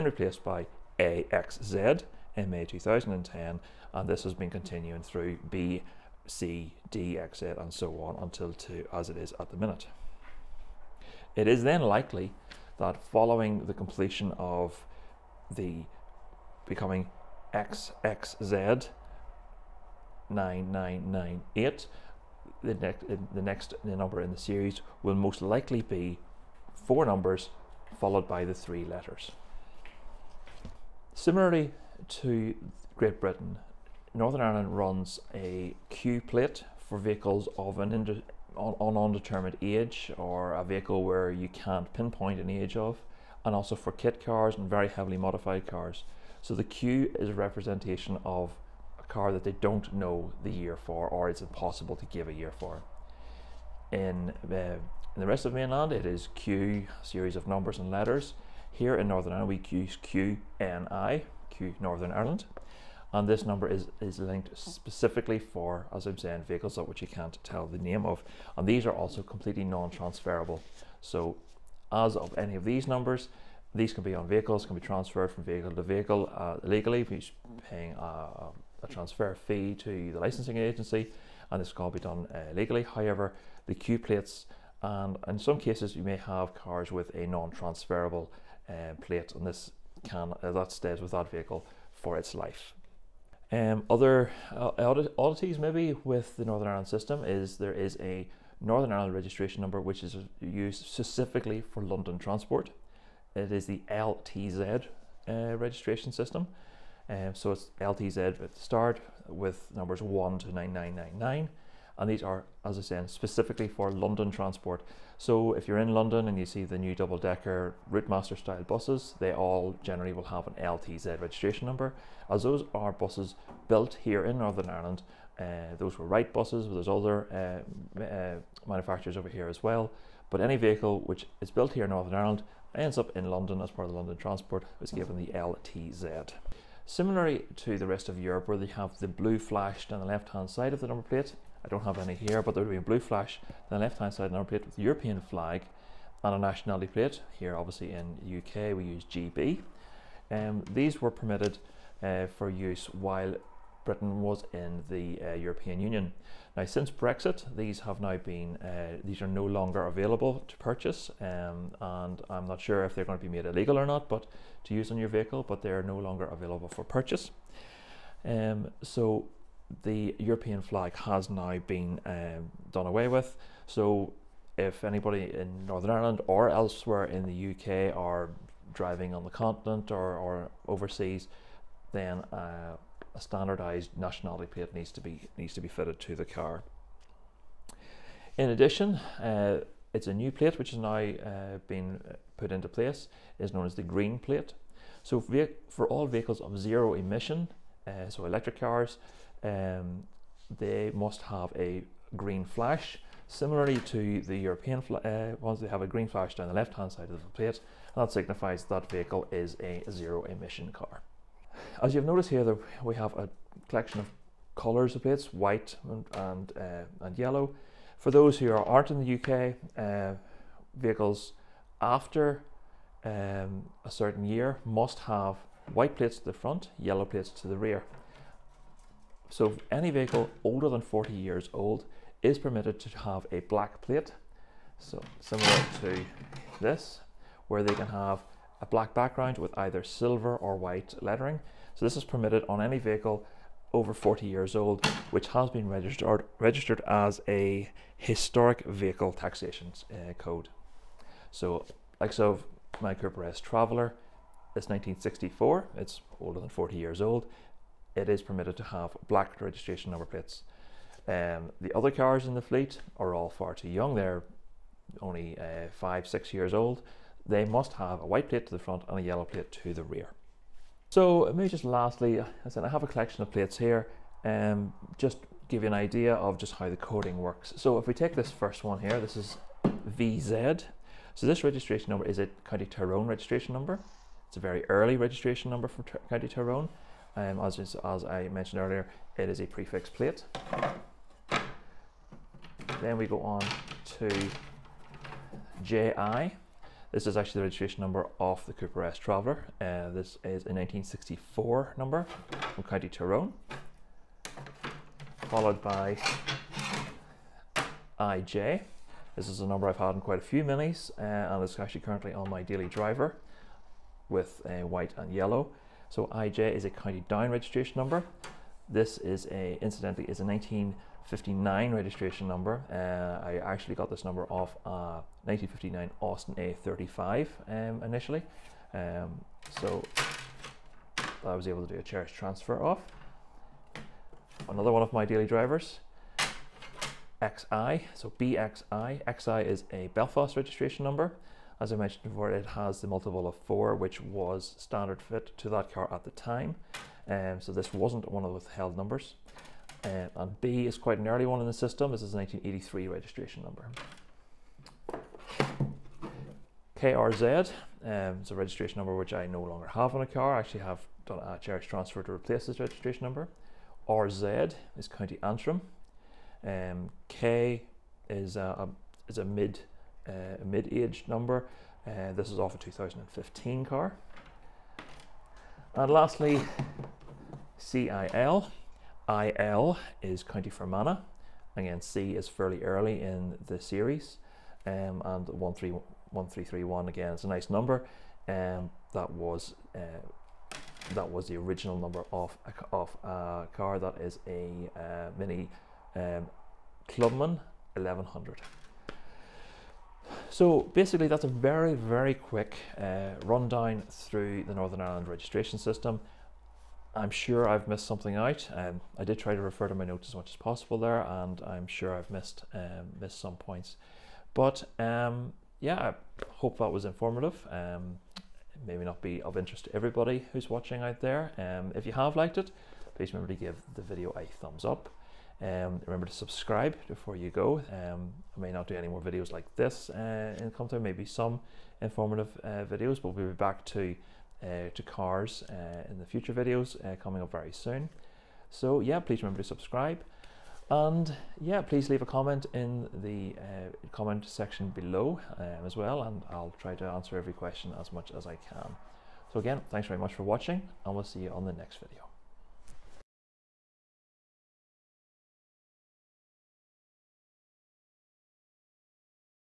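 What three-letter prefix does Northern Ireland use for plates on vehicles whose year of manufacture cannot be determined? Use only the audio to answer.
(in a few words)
QNI.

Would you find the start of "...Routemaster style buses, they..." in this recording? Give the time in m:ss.
1:57.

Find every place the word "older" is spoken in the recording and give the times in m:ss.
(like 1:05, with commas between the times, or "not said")
3:50, 4:16.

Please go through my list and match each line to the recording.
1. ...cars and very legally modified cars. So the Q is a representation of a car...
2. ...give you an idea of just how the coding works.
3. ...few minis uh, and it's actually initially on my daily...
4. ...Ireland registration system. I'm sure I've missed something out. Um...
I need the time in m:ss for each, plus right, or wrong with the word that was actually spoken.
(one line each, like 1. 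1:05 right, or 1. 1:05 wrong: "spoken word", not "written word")
1. 0:44 wrong: "heavily", not "legally"
2. 4:35 right
3. 5:10 wrong: "currently", not "initially"
4. 6:44 right.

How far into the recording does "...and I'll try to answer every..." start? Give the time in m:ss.
7:26.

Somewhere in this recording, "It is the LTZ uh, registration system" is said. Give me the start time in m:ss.
1:43.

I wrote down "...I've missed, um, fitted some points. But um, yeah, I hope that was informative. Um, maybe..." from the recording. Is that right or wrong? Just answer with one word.
wrong.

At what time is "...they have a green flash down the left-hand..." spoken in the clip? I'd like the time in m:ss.
3:25.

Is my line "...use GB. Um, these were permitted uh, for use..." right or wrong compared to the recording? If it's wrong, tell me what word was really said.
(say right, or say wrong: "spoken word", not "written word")
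right.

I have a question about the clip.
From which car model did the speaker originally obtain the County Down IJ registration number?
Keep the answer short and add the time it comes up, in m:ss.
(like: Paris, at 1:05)
Austin A35, at 5:26.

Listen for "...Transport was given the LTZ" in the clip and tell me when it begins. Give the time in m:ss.
2:14.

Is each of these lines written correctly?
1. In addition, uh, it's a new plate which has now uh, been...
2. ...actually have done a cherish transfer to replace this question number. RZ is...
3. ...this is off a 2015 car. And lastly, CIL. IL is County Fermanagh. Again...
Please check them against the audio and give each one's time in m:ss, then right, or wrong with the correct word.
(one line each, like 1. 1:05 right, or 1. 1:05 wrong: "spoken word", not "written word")
1. 3:08 right
2. 6:00 wrong: "registration", not "question"
3. 6:12 right.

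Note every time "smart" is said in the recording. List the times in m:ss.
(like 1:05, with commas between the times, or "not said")
not said.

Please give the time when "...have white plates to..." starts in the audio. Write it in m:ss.
3:45.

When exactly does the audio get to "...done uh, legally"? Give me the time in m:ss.
1:21.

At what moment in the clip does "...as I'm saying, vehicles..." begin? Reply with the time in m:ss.
1:05.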